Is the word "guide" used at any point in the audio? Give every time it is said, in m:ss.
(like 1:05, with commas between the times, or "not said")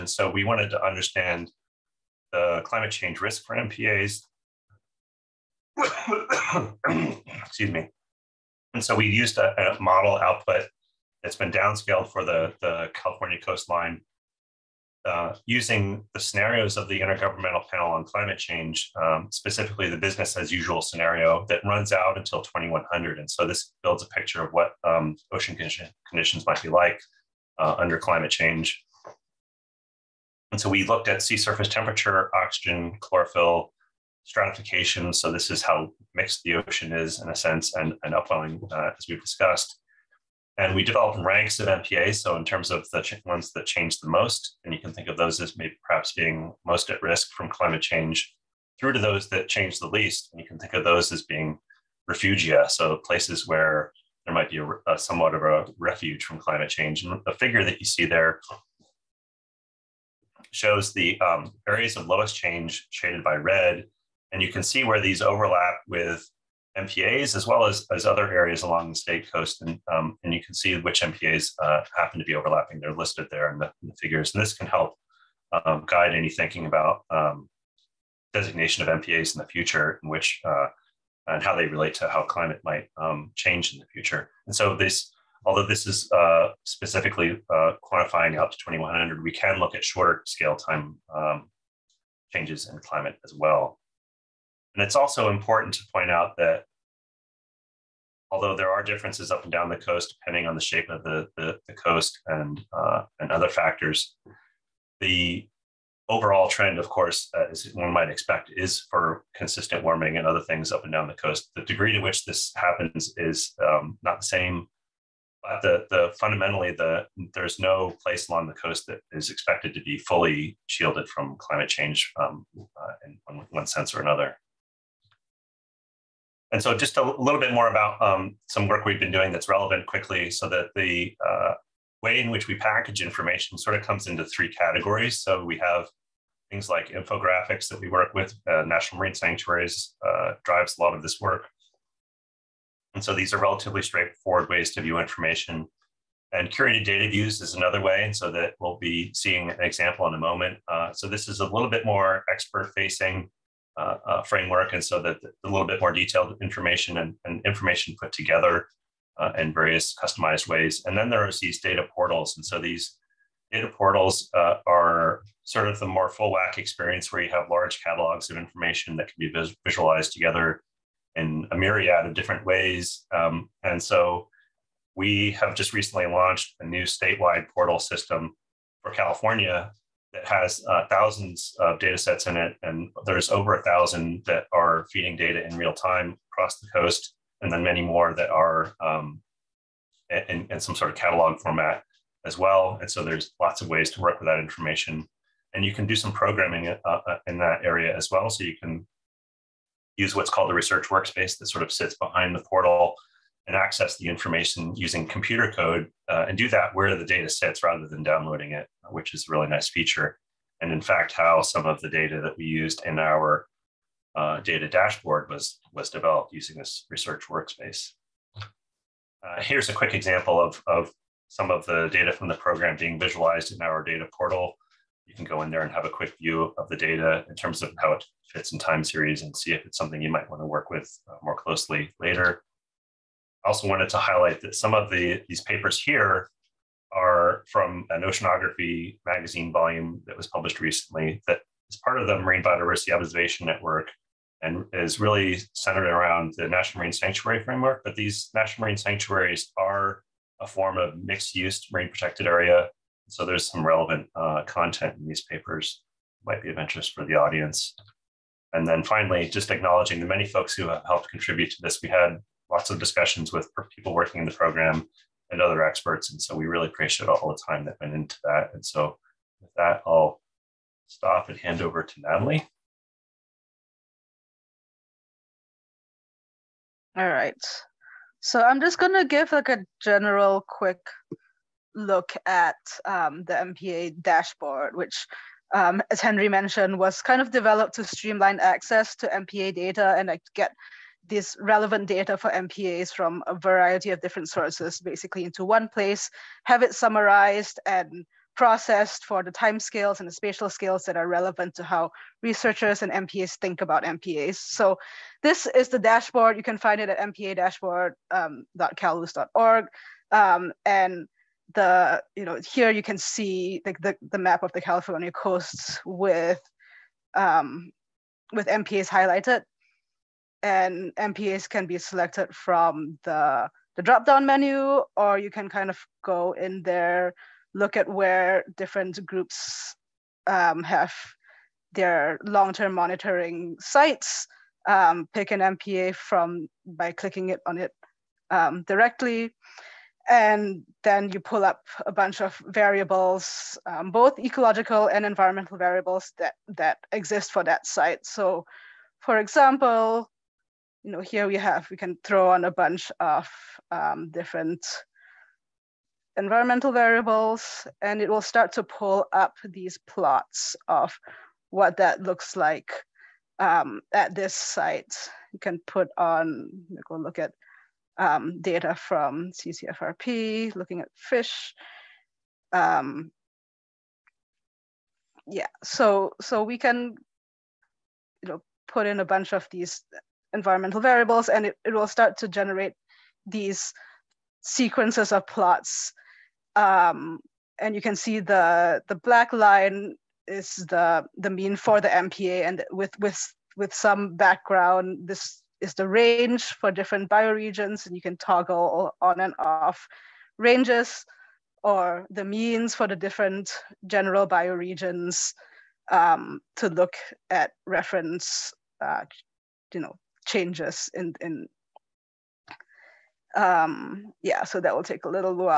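1:15.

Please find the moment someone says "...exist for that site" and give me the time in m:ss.
5:46.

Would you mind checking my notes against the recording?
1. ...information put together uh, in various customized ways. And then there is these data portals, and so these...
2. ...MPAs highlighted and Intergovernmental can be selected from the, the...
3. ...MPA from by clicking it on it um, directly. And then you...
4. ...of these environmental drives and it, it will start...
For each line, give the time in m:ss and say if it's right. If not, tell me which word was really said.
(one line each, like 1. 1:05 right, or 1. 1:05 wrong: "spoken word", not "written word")
1. 2:37 right
2. 5:18 wrong: "MPAs", not "Intergovernmental"
3. 5:35 right
4. 6:19 wrong: "variables", not "drives".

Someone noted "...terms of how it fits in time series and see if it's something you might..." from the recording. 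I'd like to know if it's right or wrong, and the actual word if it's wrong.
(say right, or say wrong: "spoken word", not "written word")
right.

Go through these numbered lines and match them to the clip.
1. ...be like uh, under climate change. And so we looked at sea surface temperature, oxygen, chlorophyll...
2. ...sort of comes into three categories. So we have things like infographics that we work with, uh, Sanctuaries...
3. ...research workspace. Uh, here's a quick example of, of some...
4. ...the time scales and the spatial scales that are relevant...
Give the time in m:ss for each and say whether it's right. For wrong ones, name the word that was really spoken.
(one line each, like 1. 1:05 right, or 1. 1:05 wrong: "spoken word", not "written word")
1. 0:26 right
2. 2:13 wrong: "National", not "Sanctuaries"
3. 3:36 right
4. 4:59 right.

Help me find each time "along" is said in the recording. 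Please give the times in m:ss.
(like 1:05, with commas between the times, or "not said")
1:08, 1:58.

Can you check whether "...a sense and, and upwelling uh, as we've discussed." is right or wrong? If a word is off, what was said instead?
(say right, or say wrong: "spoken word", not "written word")
right.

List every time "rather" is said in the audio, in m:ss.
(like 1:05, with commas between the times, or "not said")
3:27.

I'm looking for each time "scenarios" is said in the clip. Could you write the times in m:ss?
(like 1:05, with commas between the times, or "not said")
0:16, 0:20.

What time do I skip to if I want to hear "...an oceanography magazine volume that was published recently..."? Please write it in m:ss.
3:57.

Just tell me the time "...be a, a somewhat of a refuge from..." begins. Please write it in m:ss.
0:54.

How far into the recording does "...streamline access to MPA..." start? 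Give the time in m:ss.
4:47.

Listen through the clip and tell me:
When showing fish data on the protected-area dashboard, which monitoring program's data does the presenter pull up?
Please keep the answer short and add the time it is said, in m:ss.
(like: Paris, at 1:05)
CCFRP, at 6:09.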